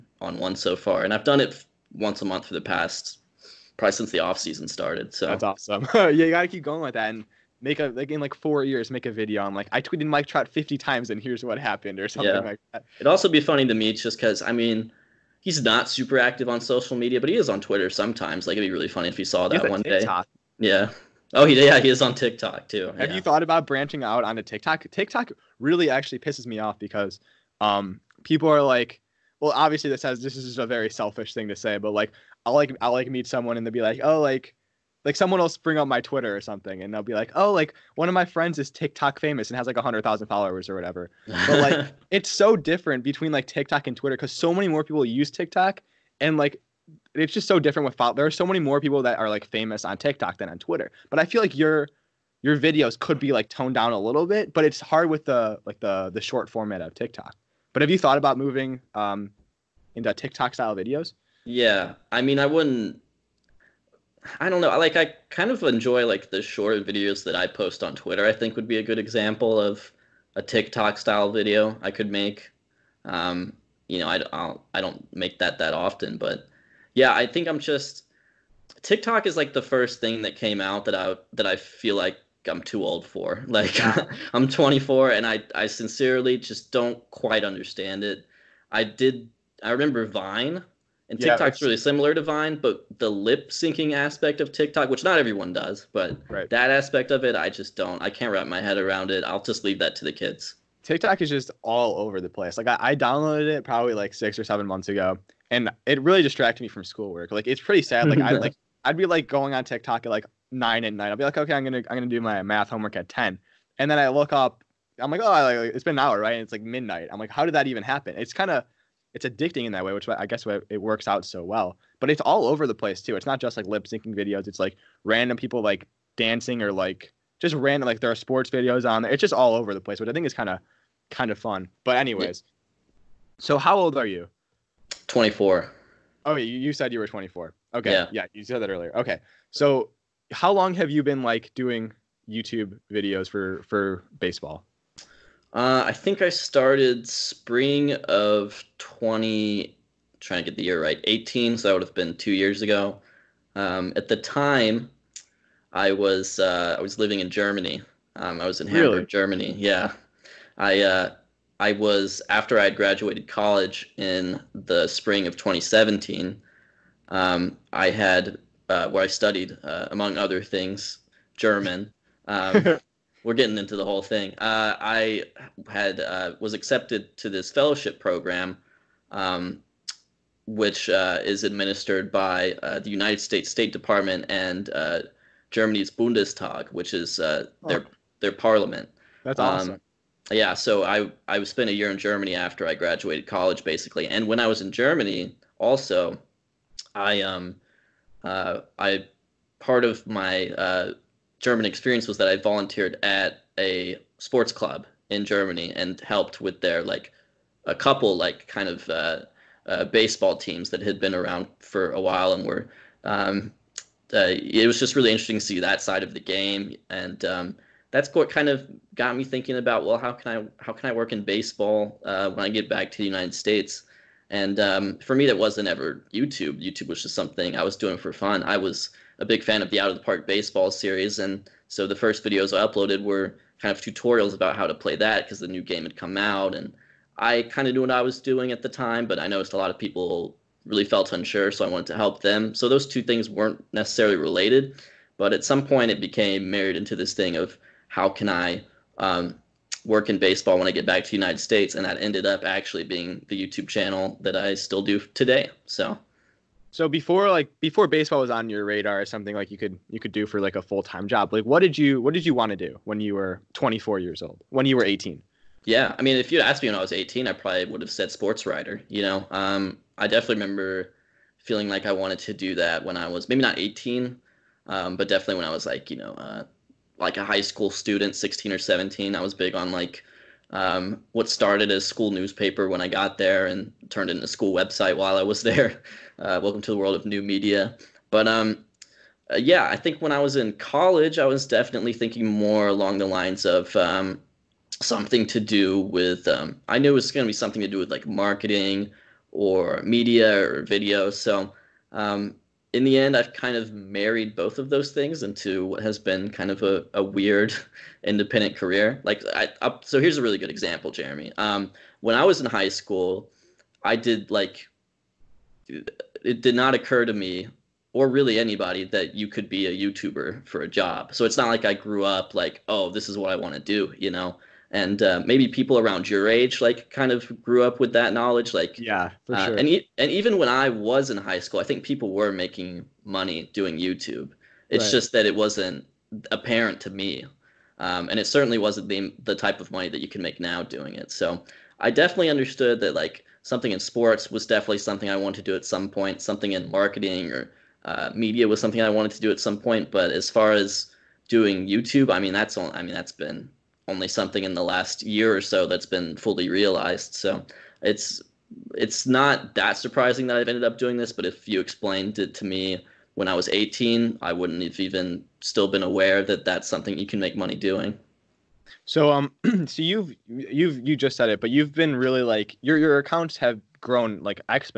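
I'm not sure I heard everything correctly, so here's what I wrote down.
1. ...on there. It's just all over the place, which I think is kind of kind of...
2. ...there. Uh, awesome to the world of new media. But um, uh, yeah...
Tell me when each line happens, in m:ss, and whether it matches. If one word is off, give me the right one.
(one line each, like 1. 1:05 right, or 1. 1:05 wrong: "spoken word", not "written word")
1. 2:08 right
2. 4:45 wrong: "welcome", not "awesome".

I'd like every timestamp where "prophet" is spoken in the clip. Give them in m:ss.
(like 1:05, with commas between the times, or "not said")
not said.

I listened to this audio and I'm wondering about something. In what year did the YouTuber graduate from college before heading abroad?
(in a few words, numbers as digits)
2017.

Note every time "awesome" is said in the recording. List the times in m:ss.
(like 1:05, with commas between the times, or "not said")
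0:05, 3:09.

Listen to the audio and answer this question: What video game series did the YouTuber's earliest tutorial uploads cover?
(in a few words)
Out of the Park Baseball.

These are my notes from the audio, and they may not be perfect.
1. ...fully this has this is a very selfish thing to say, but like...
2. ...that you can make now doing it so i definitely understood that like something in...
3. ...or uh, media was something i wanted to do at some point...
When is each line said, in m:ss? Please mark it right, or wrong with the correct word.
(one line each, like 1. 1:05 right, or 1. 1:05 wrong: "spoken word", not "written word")
1. 0:29 wrong: "obviously", not "fully"
2. 5:39 right
3. 5:47 right.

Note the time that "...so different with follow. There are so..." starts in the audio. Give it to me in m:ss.
0:47.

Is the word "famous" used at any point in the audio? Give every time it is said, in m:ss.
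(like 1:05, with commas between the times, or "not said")
0:39, 0:49.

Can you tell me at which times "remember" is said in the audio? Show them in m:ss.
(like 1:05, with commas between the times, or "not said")
1:29, 4:30.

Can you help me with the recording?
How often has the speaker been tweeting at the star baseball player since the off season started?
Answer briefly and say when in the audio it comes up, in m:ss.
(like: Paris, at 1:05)
once a month, at 0:01.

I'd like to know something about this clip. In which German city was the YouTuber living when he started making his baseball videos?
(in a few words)
Hamburg.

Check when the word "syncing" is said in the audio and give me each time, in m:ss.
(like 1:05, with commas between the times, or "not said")
1:33, 2:03.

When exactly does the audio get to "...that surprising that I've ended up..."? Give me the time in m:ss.
5:59.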